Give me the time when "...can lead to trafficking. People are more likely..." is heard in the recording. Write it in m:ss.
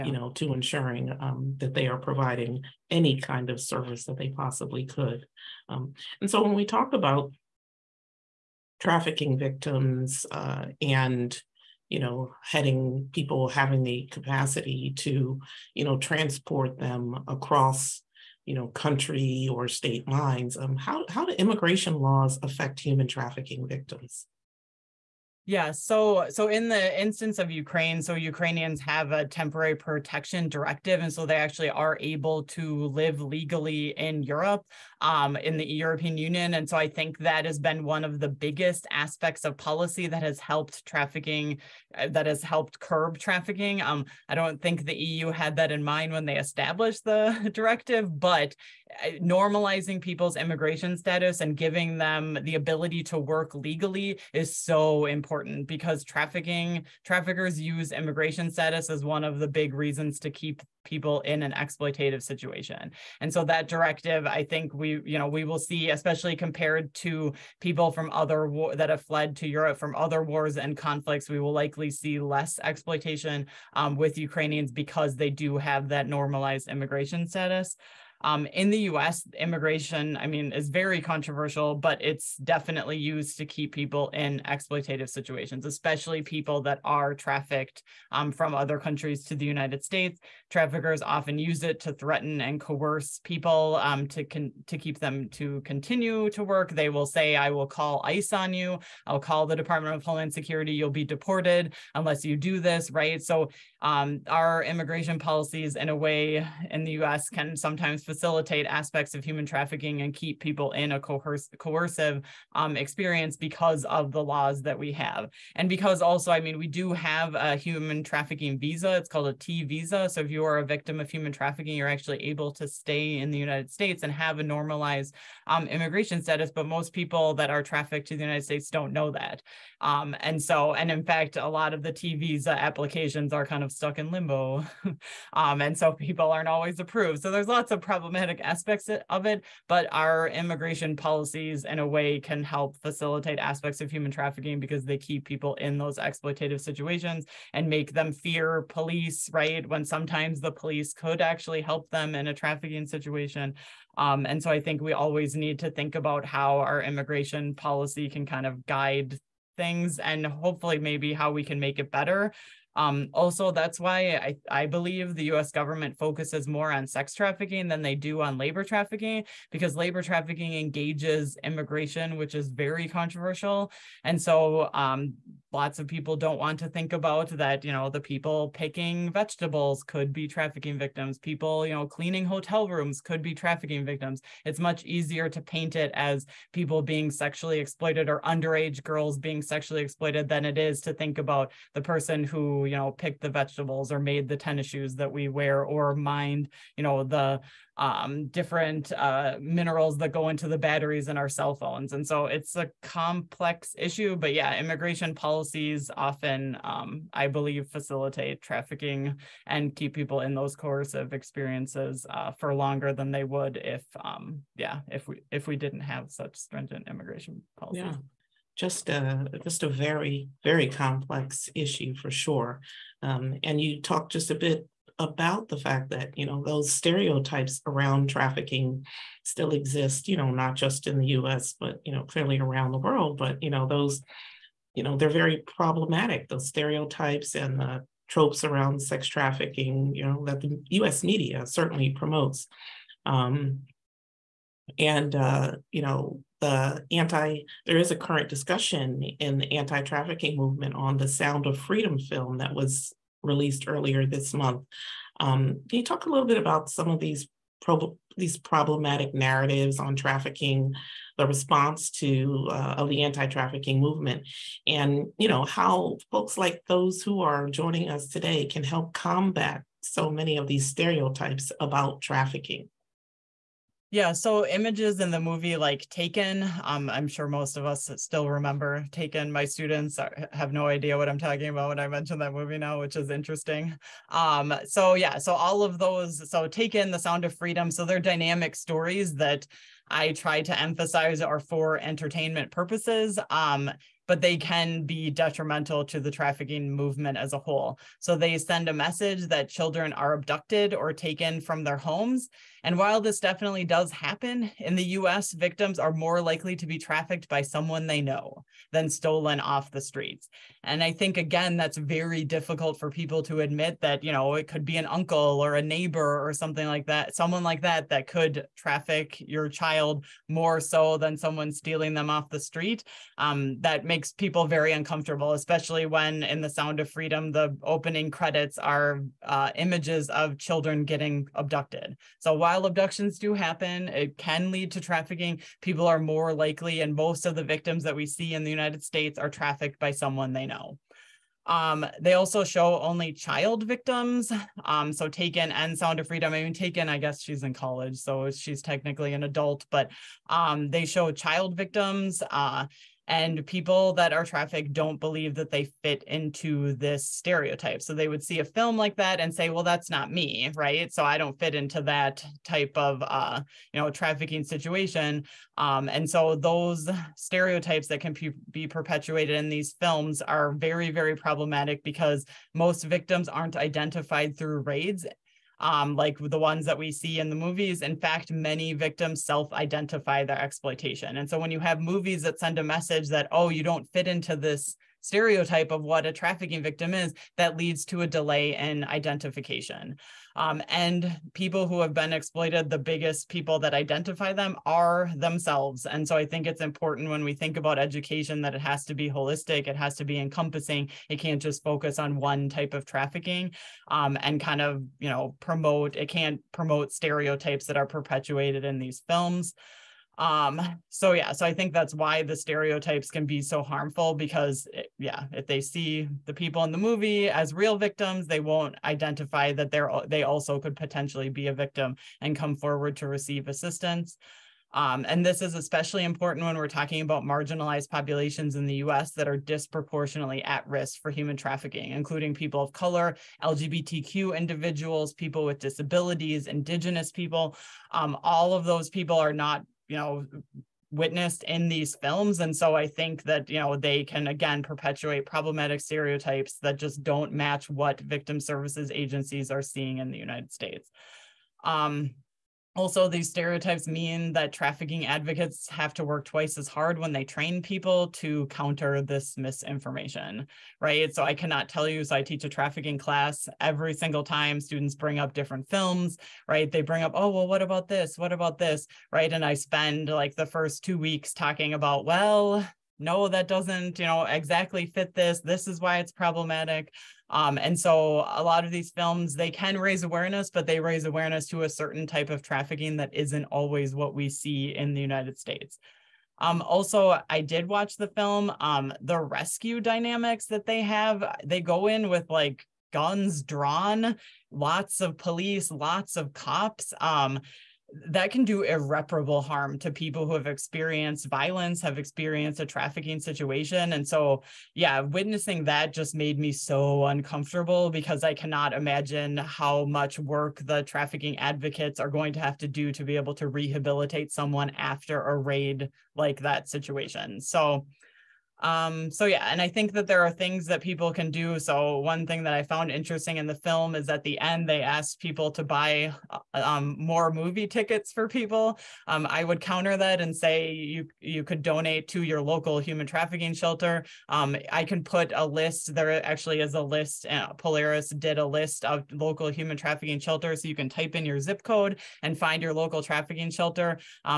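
5:34.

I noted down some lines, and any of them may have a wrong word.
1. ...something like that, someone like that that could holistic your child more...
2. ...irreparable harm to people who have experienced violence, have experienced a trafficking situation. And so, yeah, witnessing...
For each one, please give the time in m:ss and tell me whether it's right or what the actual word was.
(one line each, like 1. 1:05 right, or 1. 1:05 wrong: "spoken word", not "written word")
1. 5:16 wrong: "traffic", not "holistic"
2. 8:18 right.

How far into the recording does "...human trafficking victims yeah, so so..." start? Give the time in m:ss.
0:22.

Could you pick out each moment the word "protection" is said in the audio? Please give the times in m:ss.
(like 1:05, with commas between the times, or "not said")
0:29.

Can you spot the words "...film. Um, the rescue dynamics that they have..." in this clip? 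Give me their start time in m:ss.
8:08.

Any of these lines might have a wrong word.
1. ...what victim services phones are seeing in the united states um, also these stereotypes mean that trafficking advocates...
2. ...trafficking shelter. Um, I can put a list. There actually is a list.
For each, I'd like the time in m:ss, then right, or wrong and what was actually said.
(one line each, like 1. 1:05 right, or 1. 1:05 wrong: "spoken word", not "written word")
1. 7:27 wrong: "agencies", not "phones"
2. 8:53 right.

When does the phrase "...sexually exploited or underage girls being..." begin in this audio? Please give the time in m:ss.
3:07.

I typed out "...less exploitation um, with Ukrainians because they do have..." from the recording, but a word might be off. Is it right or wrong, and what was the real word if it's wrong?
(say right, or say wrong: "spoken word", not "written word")
right.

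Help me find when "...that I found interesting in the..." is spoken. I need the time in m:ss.
8:42.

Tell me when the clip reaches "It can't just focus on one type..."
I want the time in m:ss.
6:41.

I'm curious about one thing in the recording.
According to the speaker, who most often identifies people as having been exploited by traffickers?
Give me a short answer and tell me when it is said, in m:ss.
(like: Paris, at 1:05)
themselves, at 6:35.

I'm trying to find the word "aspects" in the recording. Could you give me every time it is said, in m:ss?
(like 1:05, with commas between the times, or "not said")
0:38, 1:48, 2:18, 2:23.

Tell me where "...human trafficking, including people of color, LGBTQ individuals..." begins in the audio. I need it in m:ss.
7:11.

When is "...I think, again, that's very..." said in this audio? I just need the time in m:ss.
5:10.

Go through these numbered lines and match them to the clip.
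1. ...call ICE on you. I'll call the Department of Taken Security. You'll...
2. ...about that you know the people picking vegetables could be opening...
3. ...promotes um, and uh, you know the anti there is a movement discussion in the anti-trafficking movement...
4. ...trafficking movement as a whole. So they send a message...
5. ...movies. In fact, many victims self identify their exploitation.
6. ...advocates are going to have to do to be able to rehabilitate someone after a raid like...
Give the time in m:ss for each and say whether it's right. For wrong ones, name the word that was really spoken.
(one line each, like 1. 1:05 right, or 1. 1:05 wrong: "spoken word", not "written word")
1. 1:37 wrong: "Homeland", not "Taken"
2. 2:56 wrong: "trafficking", not "opening"
3. 4:01 wrong: "current", not "movement"
4. 4:56 right
5. 6:17 right
6. 8:31 right.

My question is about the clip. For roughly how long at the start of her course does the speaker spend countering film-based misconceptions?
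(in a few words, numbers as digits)
2 weeks.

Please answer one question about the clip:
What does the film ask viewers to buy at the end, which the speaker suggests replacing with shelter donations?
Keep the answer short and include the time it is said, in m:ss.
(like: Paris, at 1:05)
movie tickets, at 8:47.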